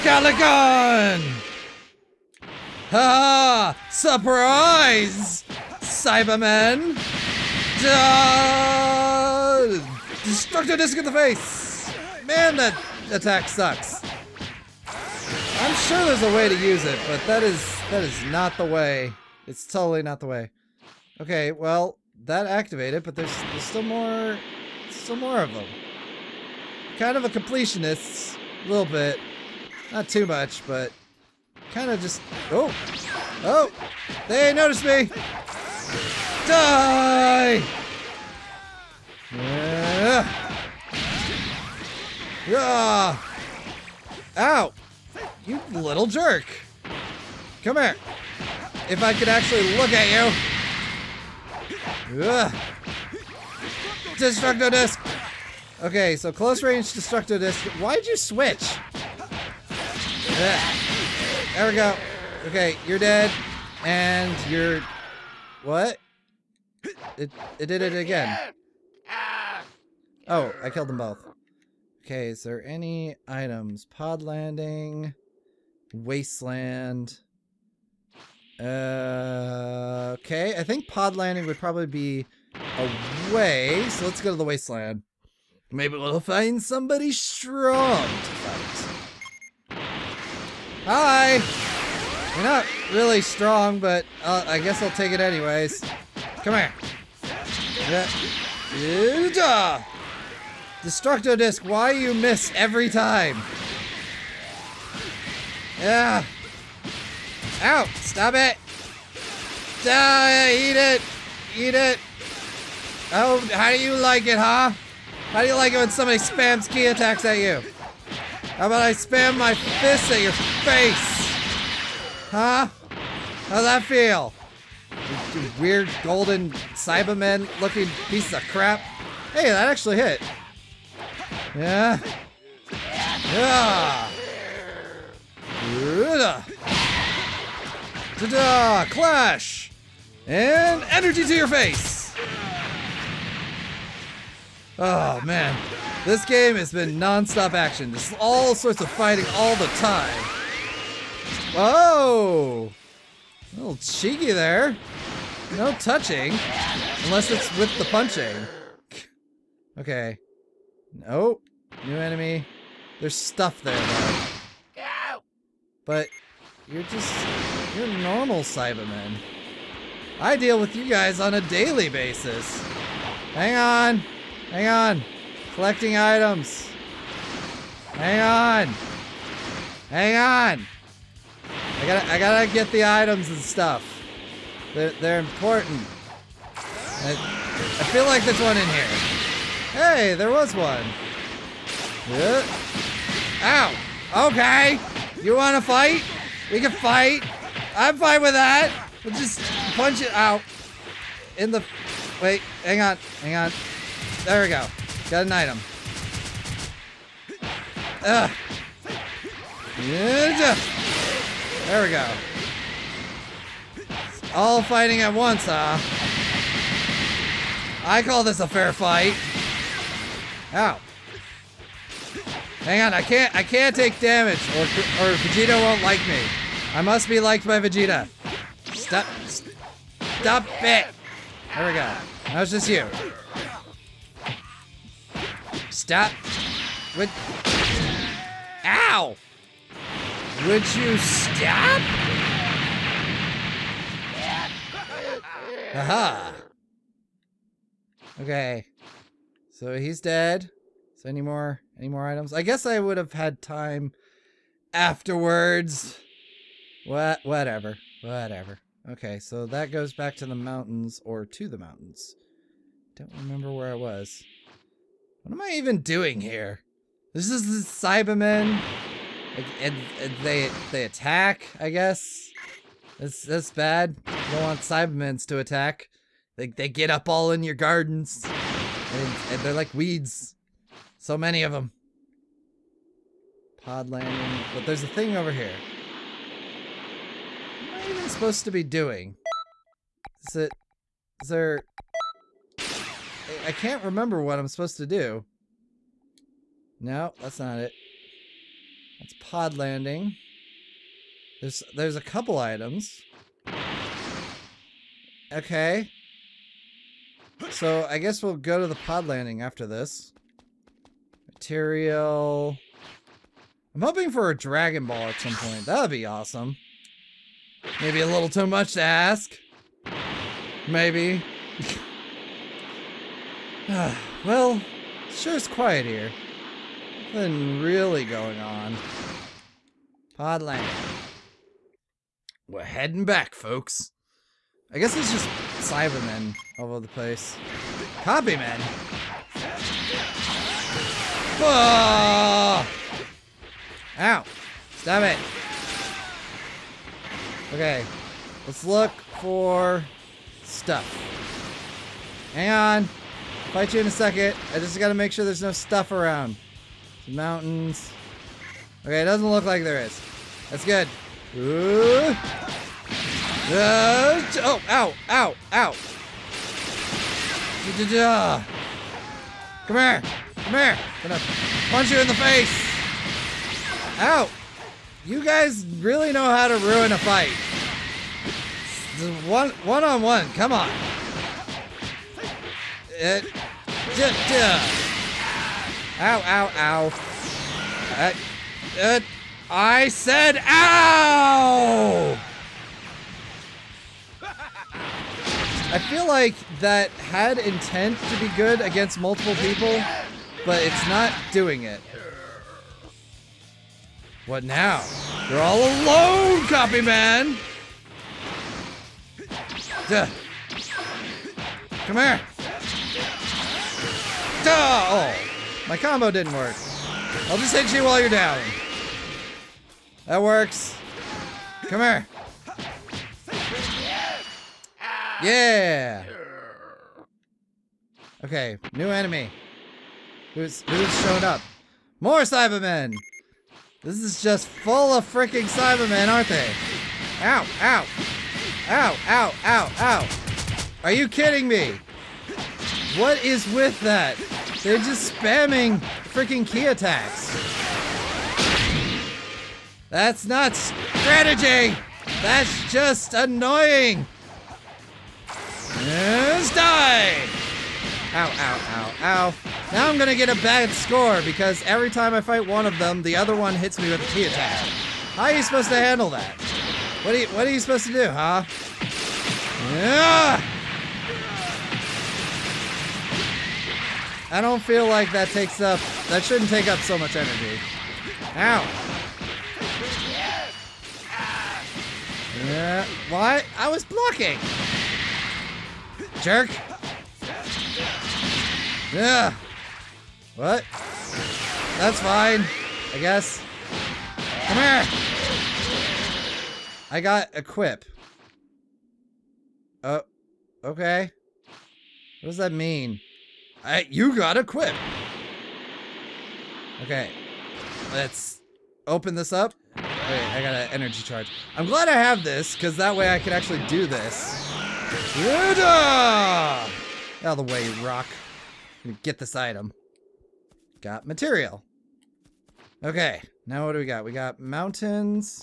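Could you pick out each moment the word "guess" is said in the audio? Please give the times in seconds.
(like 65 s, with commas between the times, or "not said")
94 s, 252 s, 271 s, 307 s, 334 s, 492 s.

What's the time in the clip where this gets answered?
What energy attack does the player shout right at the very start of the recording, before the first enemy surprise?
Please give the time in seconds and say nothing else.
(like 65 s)
0 s.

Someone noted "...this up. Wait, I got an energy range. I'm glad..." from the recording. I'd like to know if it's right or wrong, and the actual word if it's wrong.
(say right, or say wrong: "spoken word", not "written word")
wrong: "charge", not "range".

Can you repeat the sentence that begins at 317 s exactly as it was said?
Maybe a little too much to ask.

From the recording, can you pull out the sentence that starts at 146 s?
This game has been non-stop action.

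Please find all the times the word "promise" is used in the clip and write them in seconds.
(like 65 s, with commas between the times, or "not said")
not said.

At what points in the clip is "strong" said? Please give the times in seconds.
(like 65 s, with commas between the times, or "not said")
87 s, 93 s.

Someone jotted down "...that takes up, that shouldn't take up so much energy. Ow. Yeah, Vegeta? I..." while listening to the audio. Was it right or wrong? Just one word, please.
wrong.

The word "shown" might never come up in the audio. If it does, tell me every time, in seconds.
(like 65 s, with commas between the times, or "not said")
431 s.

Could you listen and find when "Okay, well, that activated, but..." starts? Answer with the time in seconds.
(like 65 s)
21 s.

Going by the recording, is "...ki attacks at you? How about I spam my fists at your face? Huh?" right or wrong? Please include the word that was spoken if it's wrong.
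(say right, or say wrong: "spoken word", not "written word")
right.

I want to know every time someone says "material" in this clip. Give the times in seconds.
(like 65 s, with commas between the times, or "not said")
311 s, 521 s.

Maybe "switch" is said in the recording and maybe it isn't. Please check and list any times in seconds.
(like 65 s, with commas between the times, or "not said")
58 s.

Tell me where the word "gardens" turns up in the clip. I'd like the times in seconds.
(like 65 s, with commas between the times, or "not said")
277 s.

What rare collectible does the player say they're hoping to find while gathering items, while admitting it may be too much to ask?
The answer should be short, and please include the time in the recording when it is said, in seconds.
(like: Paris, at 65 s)
Dragon Ball, at 314 s.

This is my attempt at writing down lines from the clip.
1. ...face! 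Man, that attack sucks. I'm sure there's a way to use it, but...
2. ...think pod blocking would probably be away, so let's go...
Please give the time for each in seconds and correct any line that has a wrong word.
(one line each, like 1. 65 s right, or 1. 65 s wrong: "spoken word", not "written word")
1. 11 s right
2. 80 s wrong: "landing", not "blocking".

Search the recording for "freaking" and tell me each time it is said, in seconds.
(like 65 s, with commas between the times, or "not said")
435 s, 446 s.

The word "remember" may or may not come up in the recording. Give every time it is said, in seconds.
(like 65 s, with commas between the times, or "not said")
263 s, 293 s.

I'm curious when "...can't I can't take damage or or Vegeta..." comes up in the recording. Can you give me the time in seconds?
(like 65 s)
223 s.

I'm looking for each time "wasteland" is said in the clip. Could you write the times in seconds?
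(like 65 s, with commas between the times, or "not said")
75 s, 84 s.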